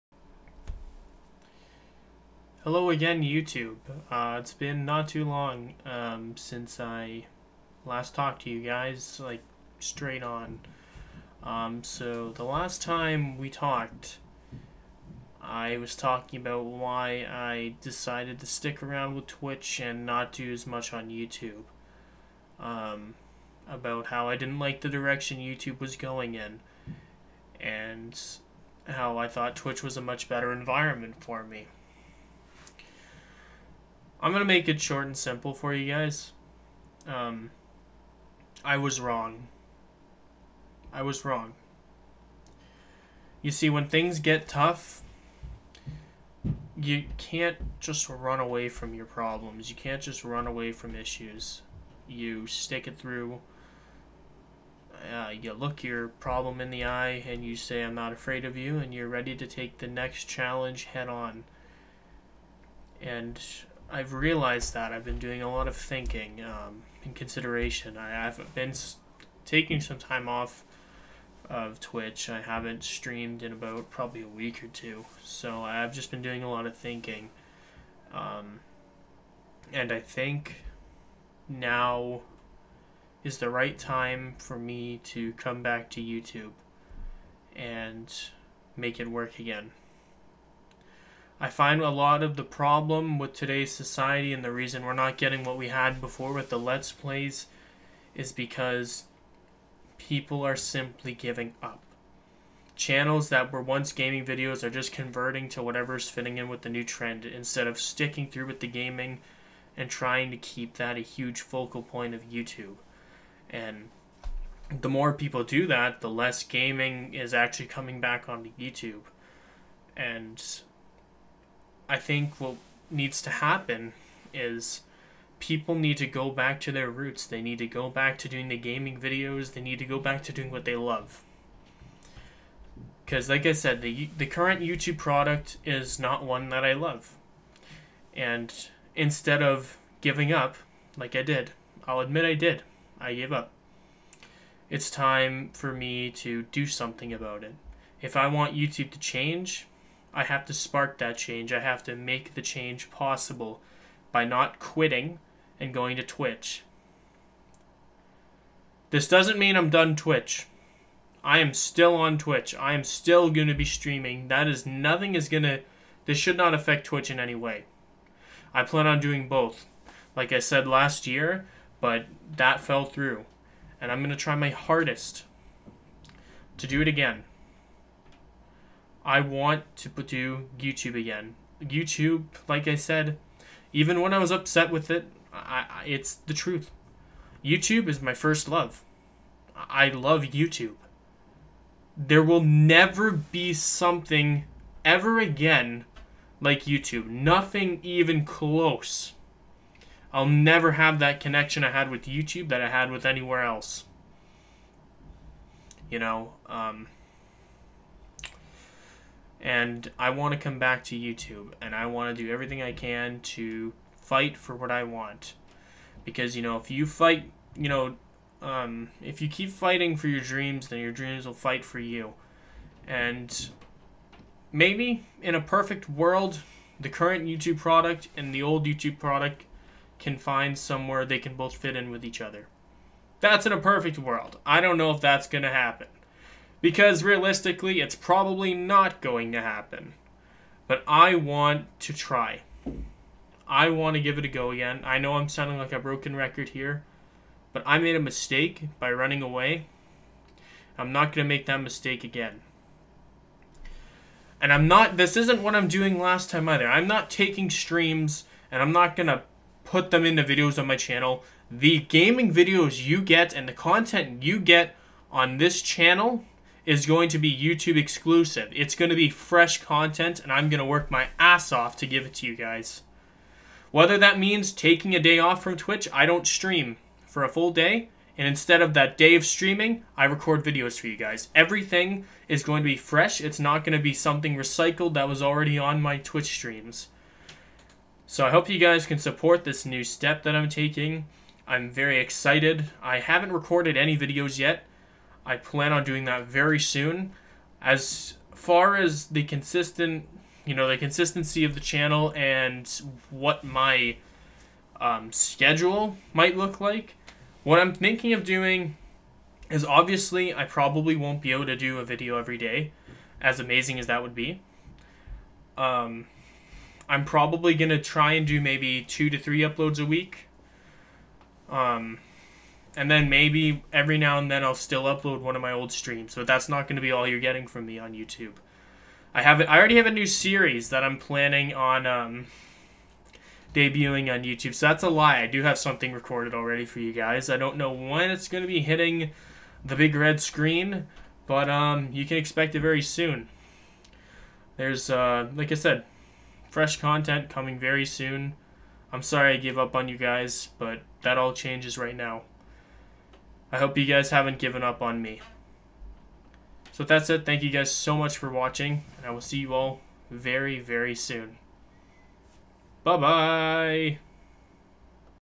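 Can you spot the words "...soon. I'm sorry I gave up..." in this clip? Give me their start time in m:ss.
5:47.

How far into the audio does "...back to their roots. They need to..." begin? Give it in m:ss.
2:06.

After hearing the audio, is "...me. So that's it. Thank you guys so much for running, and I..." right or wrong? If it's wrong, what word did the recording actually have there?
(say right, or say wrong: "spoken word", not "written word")
wrong: "watching", not "running".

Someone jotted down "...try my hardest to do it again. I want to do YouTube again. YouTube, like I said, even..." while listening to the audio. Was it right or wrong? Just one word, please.
right.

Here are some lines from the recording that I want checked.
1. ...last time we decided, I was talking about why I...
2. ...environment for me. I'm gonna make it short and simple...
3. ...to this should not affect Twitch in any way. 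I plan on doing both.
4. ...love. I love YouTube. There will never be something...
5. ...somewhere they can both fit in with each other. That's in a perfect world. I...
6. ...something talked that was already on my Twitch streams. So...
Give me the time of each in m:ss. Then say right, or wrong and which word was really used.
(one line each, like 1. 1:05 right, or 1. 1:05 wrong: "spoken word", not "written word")
1. 0:12 wrong: "talked", not "decided"
2. 0:30 right
3. 2:45 right
4. 3:08 right
5. 3:50 right
6. 4:43 wrong: "recycled", not "talked".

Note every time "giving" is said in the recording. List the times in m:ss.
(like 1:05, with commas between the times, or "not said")
1:41, 2:19.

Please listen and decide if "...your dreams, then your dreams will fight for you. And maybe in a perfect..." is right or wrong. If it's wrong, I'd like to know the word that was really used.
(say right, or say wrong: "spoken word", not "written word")
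right.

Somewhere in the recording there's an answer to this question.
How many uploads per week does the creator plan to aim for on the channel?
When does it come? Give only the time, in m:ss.
5:18.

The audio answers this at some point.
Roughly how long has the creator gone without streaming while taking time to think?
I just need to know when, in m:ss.
1:14.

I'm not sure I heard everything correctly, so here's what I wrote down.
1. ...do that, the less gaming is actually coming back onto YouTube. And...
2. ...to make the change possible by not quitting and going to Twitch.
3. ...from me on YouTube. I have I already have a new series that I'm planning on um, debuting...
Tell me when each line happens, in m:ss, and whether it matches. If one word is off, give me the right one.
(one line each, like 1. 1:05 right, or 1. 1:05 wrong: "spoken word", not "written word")
1. 1:55 right
2. 2:31 right
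3. 5:27 right.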